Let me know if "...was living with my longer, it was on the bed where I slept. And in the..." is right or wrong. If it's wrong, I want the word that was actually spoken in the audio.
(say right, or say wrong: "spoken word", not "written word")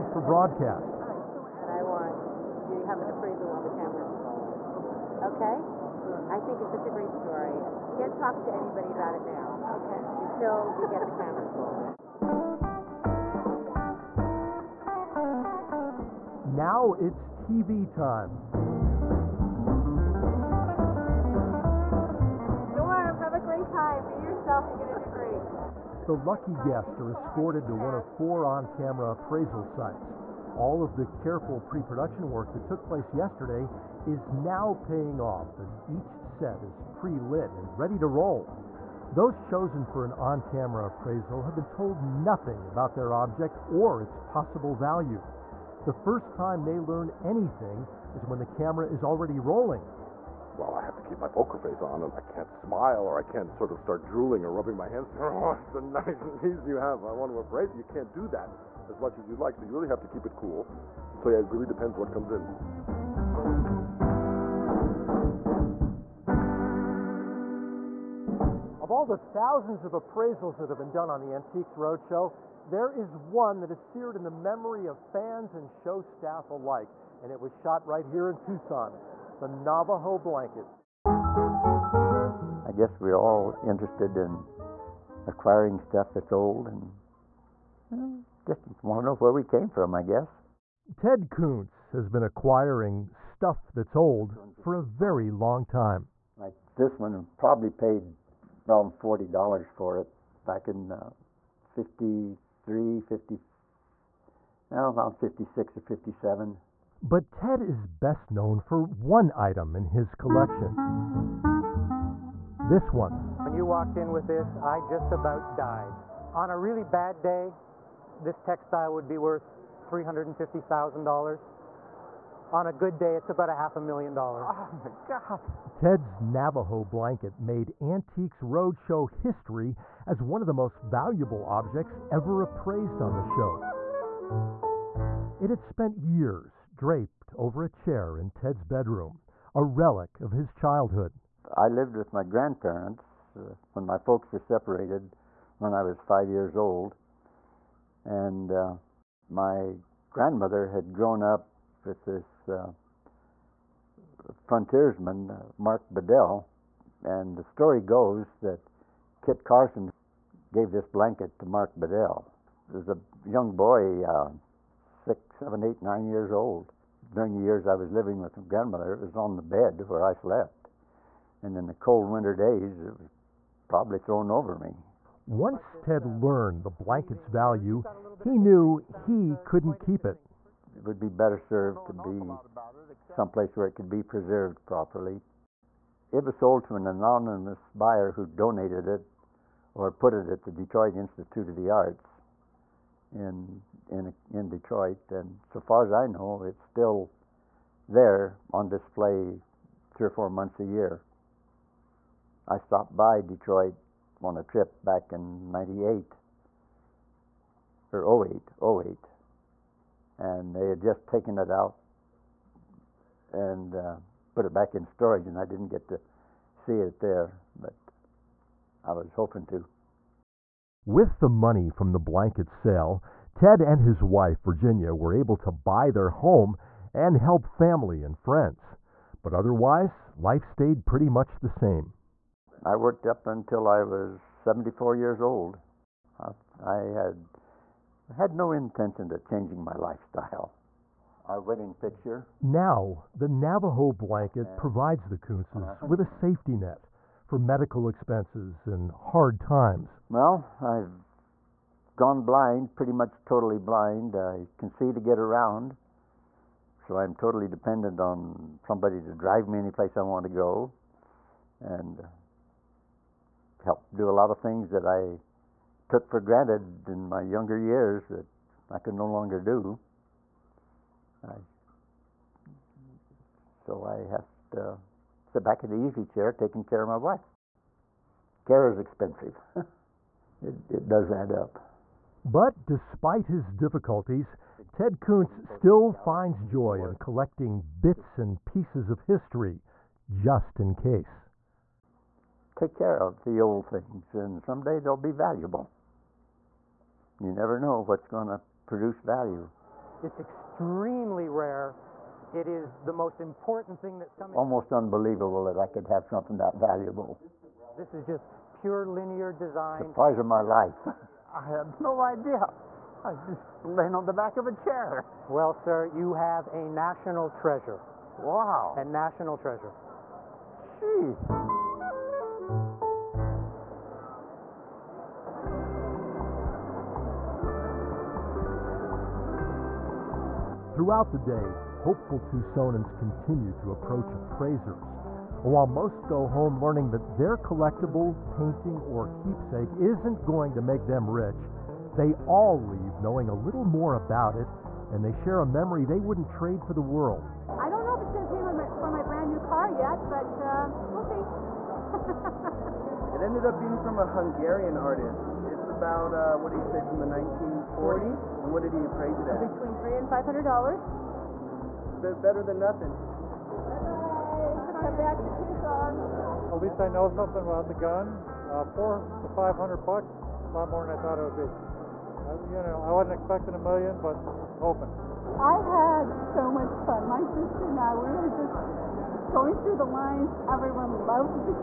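wrong: "grandmother", not "longer".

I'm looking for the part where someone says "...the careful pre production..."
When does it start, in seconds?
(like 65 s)
30 s.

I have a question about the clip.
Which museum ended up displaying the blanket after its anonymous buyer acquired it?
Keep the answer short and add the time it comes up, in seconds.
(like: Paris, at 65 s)
Detroit Institute of the Arts, at 190 s.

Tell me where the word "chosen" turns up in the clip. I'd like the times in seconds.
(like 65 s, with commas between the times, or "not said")
39 s.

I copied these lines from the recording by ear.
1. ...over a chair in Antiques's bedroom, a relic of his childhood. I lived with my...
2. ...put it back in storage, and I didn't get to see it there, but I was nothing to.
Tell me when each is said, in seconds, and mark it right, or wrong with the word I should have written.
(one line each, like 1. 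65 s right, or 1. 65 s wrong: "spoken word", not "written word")
1. 137 s wrong: "Ted", not "Antiques"
2. 214 s wrong: "hoping", not "nothing".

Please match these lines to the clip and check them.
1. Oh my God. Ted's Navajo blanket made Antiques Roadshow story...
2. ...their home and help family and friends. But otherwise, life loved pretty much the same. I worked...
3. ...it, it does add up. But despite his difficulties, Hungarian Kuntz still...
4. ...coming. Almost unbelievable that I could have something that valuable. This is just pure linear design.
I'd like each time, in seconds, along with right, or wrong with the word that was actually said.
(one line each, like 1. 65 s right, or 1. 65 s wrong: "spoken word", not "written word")
1. 124 s wrong: "history", not "story"
2. 225 s wrong: "stayed", not "loved"
3. 280 s wrong: "Ted", not "Hungarian"
4. 304 s right.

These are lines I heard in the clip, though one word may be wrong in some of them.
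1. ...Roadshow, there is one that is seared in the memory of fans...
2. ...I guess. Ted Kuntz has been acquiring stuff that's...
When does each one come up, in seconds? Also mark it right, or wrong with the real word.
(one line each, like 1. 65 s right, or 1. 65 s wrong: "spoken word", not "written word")
1. 71 s right
2. 89 s right.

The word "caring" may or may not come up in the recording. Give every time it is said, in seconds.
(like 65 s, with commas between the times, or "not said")
not said.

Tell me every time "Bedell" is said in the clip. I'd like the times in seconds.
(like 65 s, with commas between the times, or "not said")
155 s, 161 s.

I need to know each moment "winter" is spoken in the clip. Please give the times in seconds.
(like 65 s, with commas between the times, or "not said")
172 s.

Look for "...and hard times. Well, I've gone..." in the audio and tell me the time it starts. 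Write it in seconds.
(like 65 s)
248 s.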